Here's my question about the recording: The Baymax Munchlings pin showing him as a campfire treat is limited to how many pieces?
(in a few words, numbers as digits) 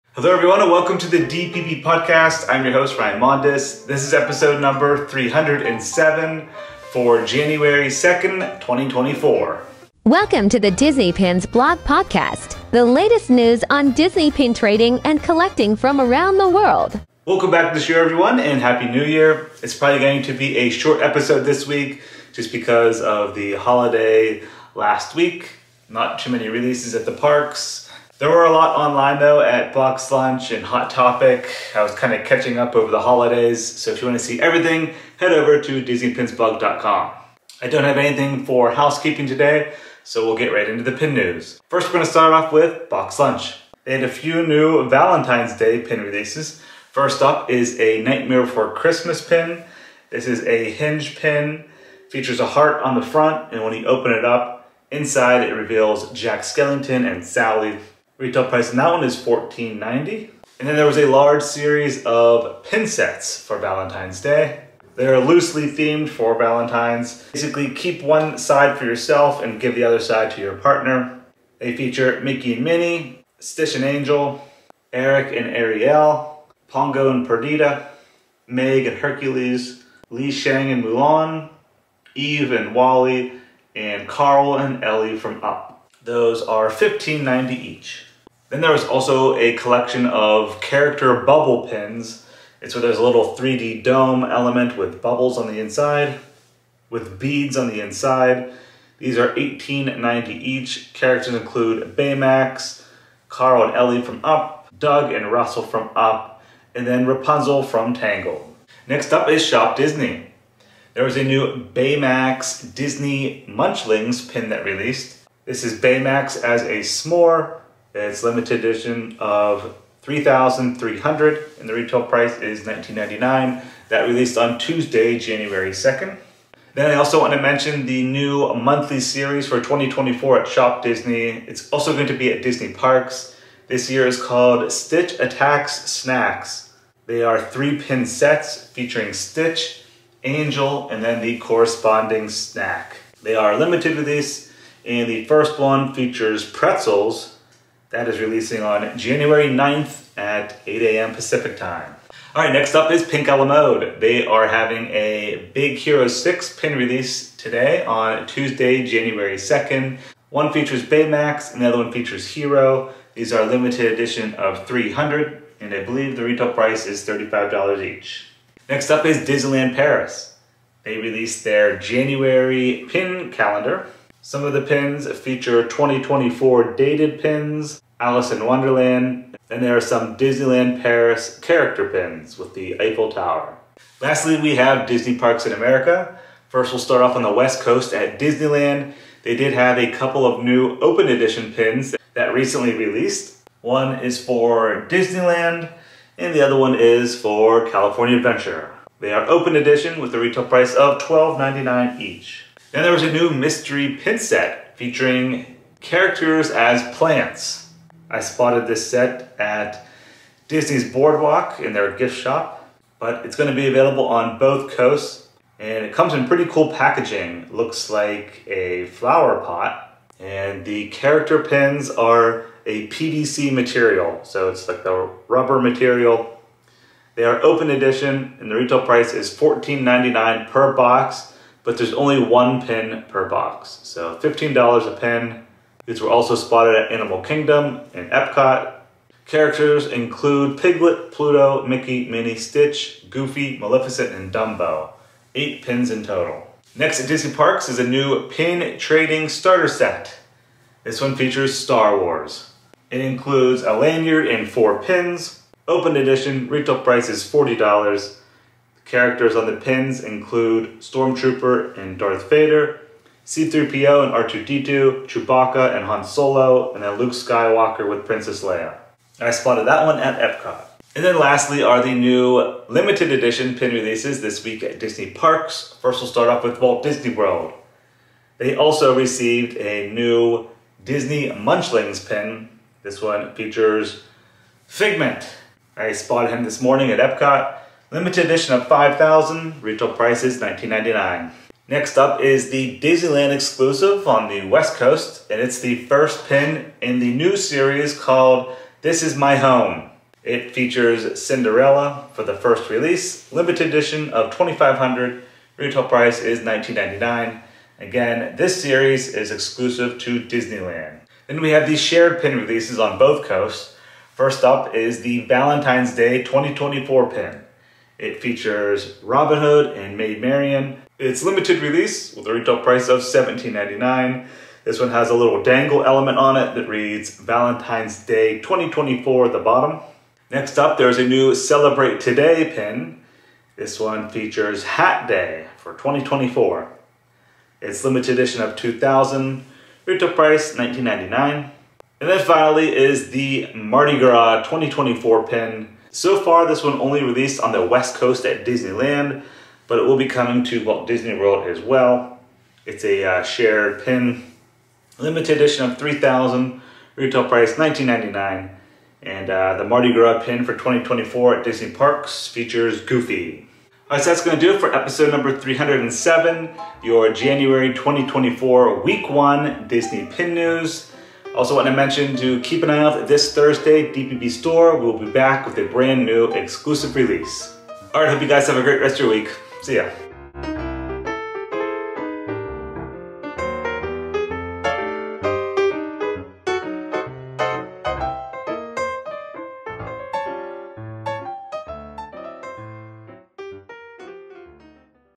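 3,300.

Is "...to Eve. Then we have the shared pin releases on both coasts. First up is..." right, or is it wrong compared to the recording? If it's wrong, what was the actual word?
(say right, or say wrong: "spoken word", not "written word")
wrong: "Disneyland", not "Eve".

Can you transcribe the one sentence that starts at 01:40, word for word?
Characters include Baymax, Carl and Ellie from Up, Doug and Russell from Up, and then Rapunzel from Tangled.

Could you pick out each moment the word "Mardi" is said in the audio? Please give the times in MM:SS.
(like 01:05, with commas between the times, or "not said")
05:43, 05:59.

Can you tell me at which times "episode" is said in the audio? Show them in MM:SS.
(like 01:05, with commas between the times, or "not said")
00:04, 00:21, 06:04.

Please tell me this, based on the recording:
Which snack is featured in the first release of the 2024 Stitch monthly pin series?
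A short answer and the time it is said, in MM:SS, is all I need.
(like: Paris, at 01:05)
pretzels, at 02:26.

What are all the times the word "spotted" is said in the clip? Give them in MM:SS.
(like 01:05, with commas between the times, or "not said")
03:28, 03:56, 04:29, 04:45.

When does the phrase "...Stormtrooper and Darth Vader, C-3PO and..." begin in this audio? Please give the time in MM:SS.
04:20.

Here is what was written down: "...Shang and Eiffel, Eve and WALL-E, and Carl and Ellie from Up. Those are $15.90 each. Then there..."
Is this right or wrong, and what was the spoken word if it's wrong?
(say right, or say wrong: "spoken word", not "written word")
wrong: "Mulan", not "Eiffel".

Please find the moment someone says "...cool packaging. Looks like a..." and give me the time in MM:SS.
03:36.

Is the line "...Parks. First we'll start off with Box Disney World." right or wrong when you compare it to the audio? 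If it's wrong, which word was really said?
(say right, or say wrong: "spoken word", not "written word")
wrong: "Walt", not "Box".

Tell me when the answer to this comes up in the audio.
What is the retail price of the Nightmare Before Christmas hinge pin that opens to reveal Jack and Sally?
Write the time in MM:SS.
00:59.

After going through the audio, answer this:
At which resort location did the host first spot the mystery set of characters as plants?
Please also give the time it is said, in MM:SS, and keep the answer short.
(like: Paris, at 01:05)
Disney's Boardwalk, at 03:30.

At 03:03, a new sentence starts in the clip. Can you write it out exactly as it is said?
Lastly, we have Disney parks in America.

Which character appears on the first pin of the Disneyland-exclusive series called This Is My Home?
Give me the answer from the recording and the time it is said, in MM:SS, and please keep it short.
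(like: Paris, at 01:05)
Cinderella, at 05:01.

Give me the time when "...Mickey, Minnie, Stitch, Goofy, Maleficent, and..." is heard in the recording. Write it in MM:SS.
04:01.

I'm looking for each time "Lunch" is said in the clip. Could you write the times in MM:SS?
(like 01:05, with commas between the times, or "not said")
00:30, 00:43.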